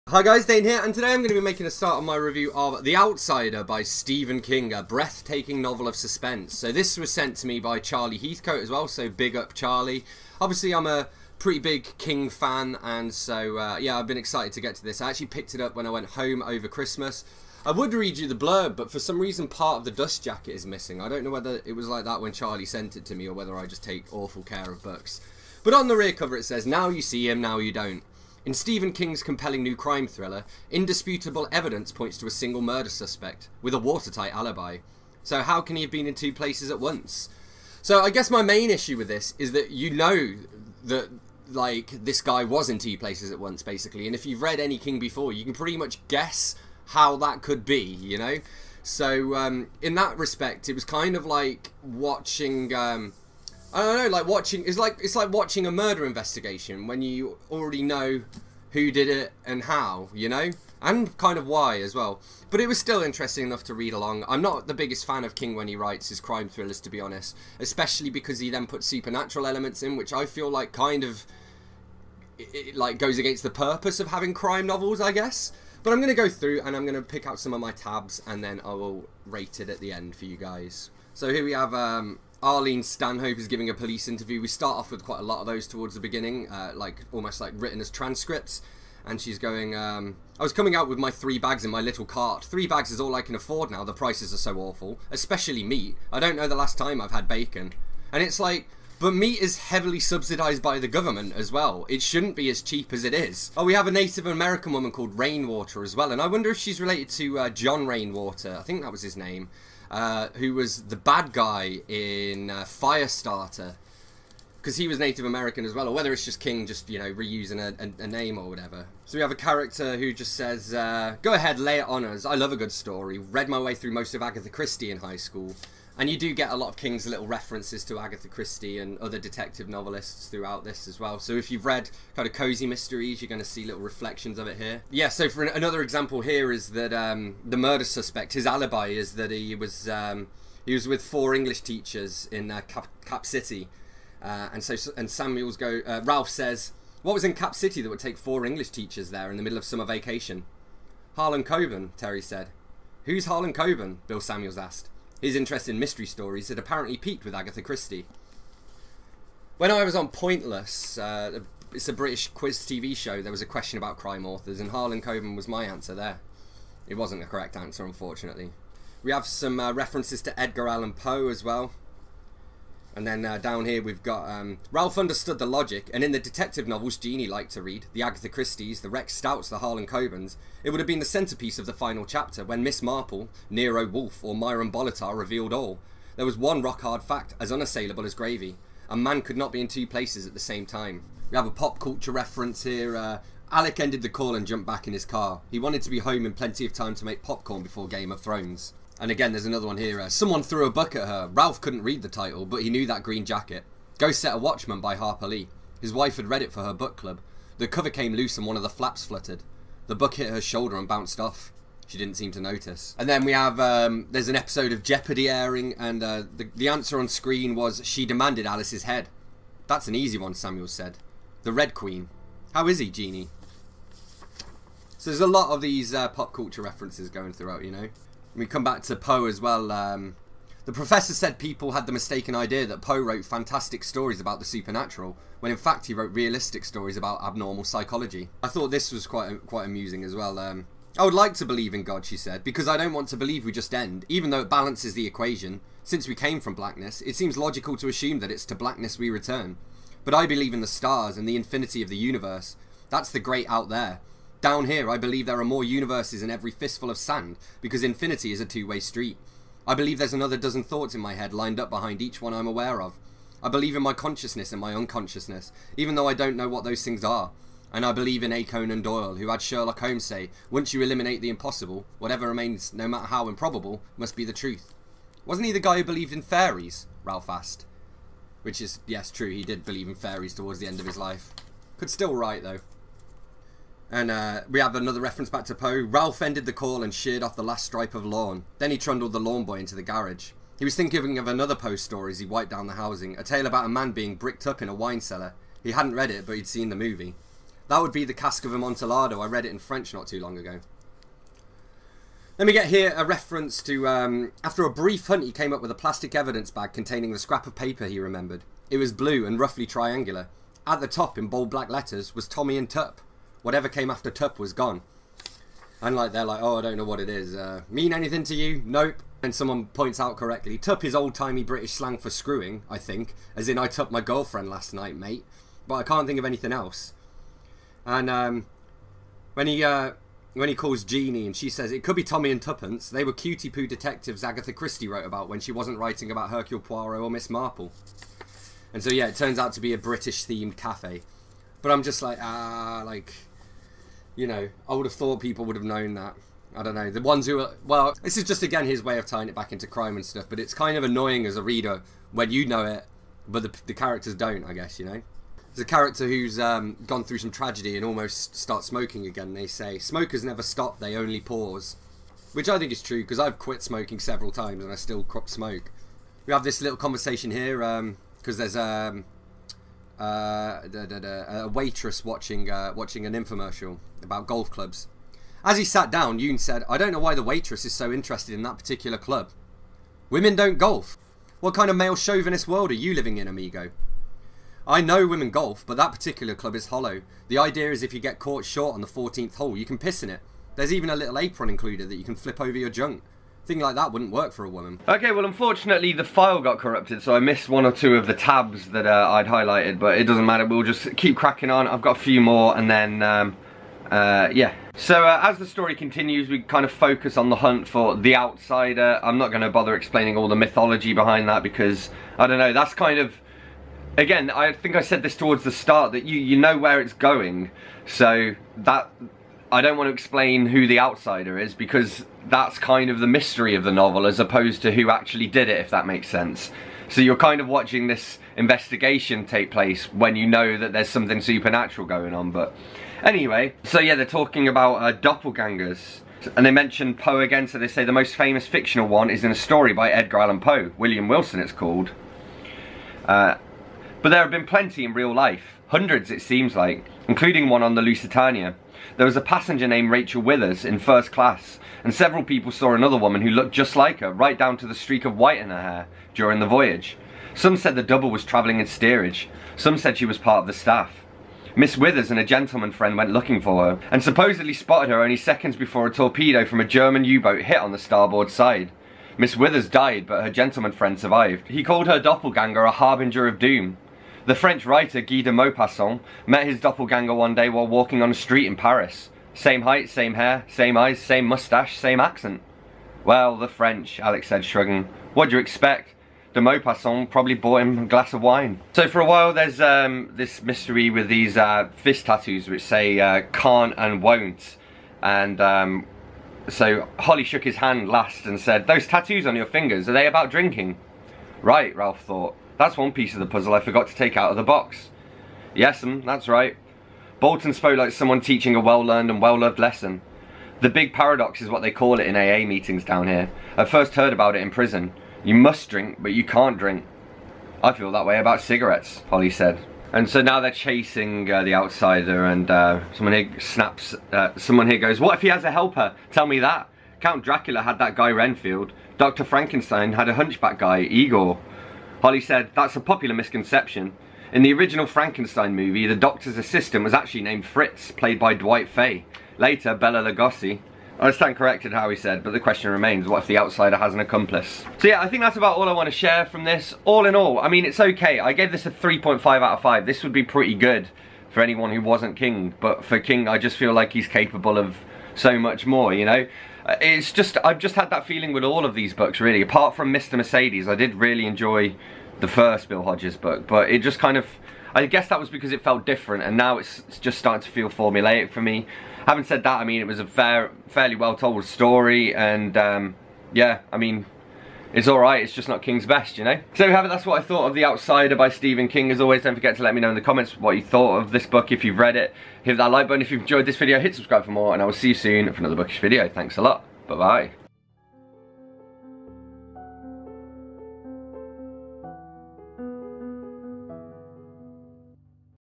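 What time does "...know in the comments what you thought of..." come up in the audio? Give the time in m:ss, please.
9:39.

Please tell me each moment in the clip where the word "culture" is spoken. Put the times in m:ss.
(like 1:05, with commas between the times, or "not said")
3:11, 3:46.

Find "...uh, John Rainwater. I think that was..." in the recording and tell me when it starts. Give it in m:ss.
1:47.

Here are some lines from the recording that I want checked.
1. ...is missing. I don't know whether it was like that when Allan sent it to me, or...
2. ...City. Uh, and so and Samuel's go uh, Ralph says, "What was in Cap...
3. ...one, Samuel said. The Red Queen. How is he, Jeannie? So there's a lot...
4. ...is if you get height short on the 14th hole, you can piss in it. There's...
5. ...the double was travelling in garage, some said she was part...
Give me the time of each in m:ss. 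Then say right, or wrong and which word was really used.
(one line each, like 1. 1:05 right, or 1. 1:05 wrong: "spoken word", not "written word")
1. 0:20 wrong: "Charlie", not "Allan"
2. 2:23 right
3. 3:40 right
4. 6:27 wrong: "caught", not "height"
5. 7:37 wrong: "steerage", not "garage".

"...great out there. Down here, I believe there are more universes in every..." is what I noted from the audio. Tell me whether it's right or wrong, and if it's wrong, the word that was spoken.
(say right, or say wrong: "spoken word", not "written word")
right.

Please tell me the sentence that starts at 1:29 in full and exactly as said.
And she's going, um, I was coming out with my three bags in my little cart.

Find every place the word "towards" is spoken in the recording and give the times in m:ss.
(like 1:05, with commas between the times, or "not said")
1:25, 4:40, 6:55.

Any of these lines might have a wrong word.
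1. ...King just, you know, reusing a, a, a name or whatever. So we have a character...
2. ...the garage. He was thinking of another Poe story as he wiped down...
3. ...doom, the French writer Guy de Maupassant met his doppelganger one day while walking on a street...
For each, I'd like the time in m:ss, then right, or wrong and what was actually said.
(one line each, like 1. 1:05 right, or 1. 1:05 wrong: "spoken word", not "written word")
1. 1:56 right
2. 4:49 right
3. 7:53 right.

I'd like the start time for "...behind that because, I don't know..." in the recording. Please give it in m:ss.
6:50.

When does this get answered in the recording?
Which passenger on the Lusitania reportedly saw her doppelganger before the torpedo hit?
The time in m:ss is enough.
7:29.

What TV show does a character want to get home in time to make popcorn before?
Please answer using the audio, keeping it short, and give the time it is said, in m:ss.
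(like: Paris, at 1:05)
Game of Thrones, at 3:17.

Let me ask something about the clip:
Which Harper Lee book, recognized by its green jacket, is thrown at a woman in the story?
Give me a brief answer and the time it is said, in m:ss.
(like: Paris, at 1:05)
Go Set a Watchman, at 3:23.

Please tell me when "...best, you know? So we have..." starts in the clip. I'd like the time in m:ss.
9:35.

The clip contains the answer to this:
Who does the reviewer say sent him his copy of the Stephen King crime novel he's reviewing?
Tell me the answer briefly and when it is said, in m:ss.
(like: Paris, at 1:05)
Charlie Heathcote, at 0:07.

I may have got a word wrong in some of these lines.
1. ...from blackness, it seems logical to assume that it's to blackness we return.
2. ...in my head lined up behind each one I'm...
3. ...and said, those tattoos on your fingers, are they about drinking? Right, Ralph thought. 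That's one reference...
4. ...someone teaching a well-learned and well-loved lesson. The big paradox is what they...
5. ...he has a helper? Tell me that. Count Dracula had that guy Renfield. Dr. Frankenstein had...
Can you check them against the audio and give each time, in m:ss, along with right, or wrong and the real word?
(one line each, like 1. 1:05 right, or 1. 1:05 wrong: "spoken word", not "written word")
1. 4:06 right
2. 4:20 right
3. 8:18 wrong: "piece", not "reference"
4. 8:27 right
5. 8:45 right.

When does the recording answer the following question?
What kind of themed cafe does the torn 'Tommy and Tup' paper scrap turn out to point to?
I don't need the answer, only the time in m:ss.
5:39.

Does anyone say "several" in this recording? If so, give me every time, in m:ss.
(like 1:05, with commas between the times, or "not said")
6:03, 7:31.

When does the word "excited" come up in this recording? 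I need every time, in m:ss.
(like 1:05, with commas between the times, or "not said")
0:14.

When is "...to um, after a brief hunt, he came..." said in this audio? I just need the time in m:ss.
5:03.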